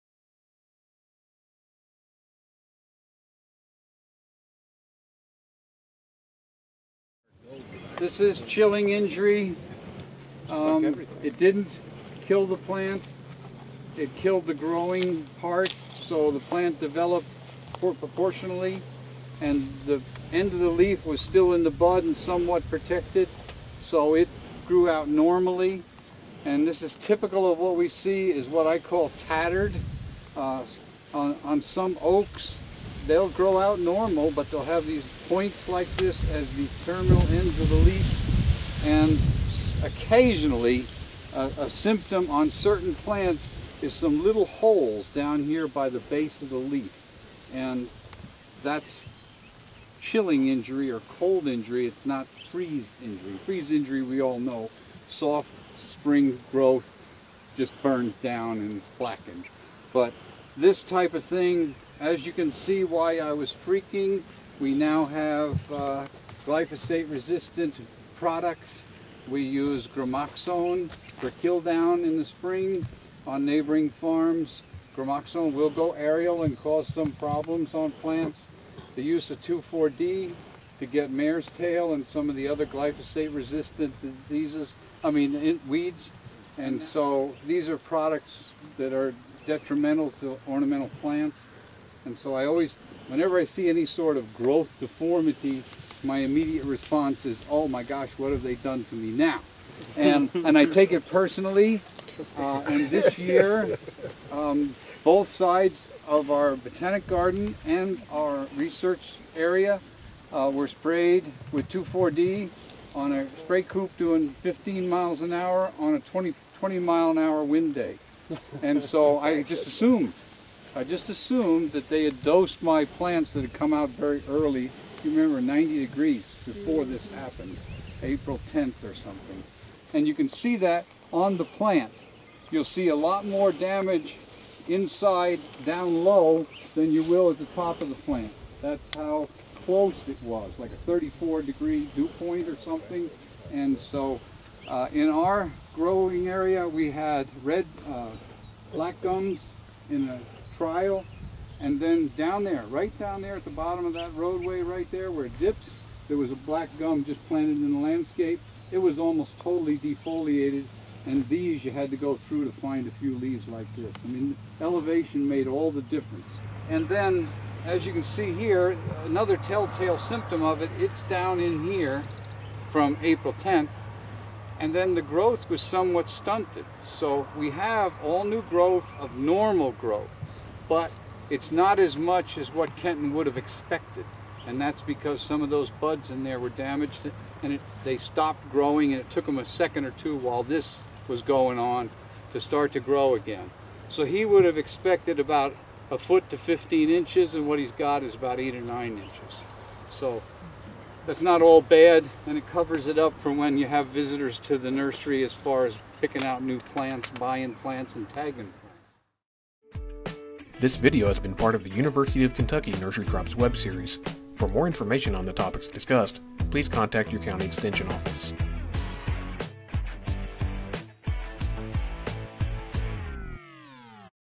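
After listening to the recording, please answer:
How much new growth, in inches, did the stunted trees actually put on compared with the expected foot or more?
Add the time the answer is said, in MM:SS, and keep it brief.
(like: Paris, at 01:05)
8 or 9 inches, at 03:18.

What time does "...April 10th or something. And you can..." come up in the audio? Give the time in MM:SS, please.
02:08.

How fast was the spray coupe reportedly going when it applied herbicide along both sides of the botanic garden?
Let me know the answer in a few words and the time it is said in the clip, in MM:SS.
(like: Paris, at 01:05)
15 miles an hour, at 01:54.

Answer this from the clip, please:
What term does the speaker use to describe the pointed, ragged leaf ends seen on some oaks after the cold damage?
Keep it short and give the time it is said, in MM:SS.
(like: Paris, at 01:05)
tattered, at 00:29.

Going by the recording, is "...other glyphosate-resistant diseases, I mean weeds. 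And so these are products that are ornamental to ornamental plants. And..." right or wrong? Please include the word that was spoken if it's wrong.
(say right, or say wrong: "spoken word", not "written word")
wrong: "detrimental", not "ornamental".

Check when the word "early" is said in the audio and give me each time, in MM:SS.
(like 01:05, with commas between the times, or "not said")
02:04.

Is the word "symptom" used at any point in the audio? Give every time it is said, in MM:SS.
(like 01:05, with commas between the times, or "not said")
00:41, 02:49.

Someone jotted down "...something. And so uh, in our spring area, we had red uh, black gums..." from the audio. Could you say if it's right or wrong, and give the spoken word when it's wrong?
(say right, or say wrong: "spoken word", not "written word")
wrong: "growing", not "spring".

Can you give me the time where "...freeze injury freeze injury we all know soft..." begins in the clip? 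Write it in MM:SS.
00:52.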